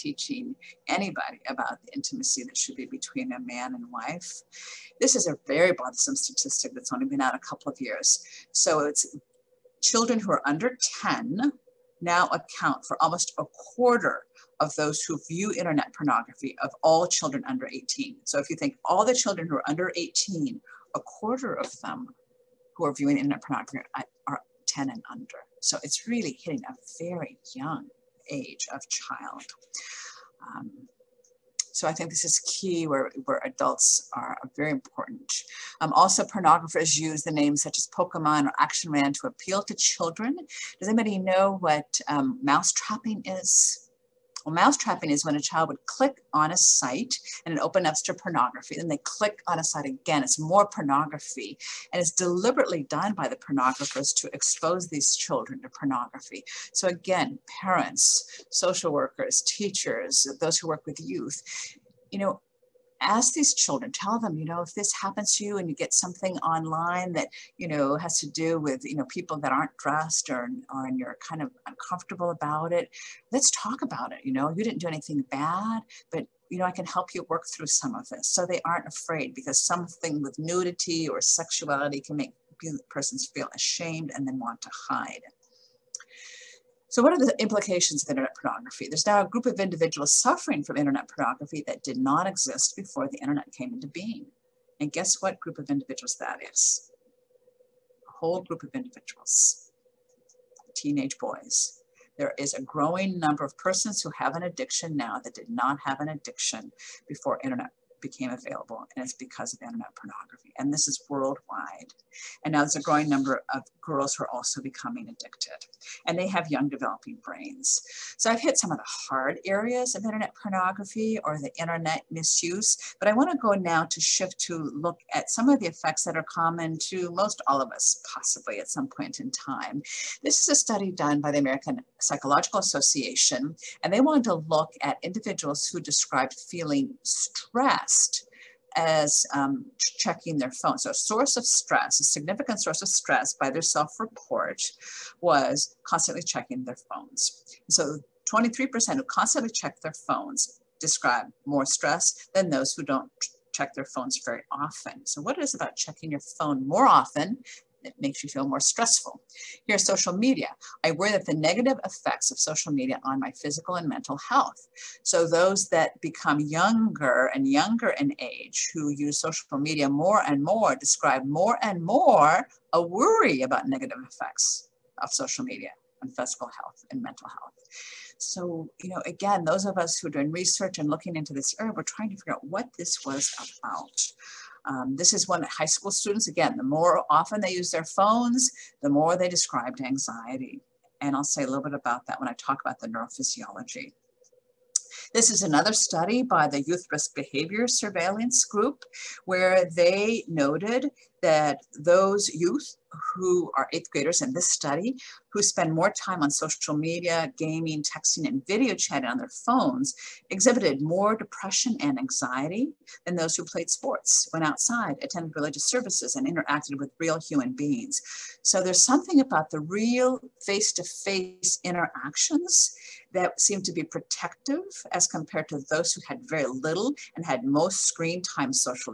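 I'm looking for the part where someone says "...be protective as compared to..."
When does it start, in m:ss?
3:43.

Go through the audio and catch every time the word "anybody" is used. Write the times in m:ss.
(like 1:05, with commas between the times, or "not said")
0:00, 0:40.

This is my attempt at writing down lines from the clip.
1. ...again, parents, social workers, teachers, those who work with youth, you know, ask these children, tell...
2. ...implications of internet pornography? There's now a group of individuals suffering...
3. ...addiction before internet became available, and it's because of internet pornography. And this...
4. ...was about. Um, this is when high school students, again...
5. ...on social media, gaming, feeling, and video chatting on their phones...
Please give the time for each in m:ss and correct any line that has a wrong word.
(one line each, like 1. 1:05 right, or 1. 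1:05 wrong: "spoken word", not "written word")
1. 0:56 right
2. 1:27 right
3. 1:46 right
4. 3:03 right
5. 3:26 wrong: "texting", not "feeling".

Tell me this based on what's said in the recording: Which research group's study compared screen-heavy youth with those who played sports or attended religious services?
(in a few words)
Youth Risk Behavior Surveillance Group.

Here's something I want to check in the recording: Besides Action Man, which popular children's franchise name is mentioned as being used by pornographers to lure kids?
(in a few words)
Pokemon.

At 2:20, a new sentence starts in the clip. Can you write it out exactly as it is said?
So a source of stress, a significant source of stress by their self-report was constantly checking their phones.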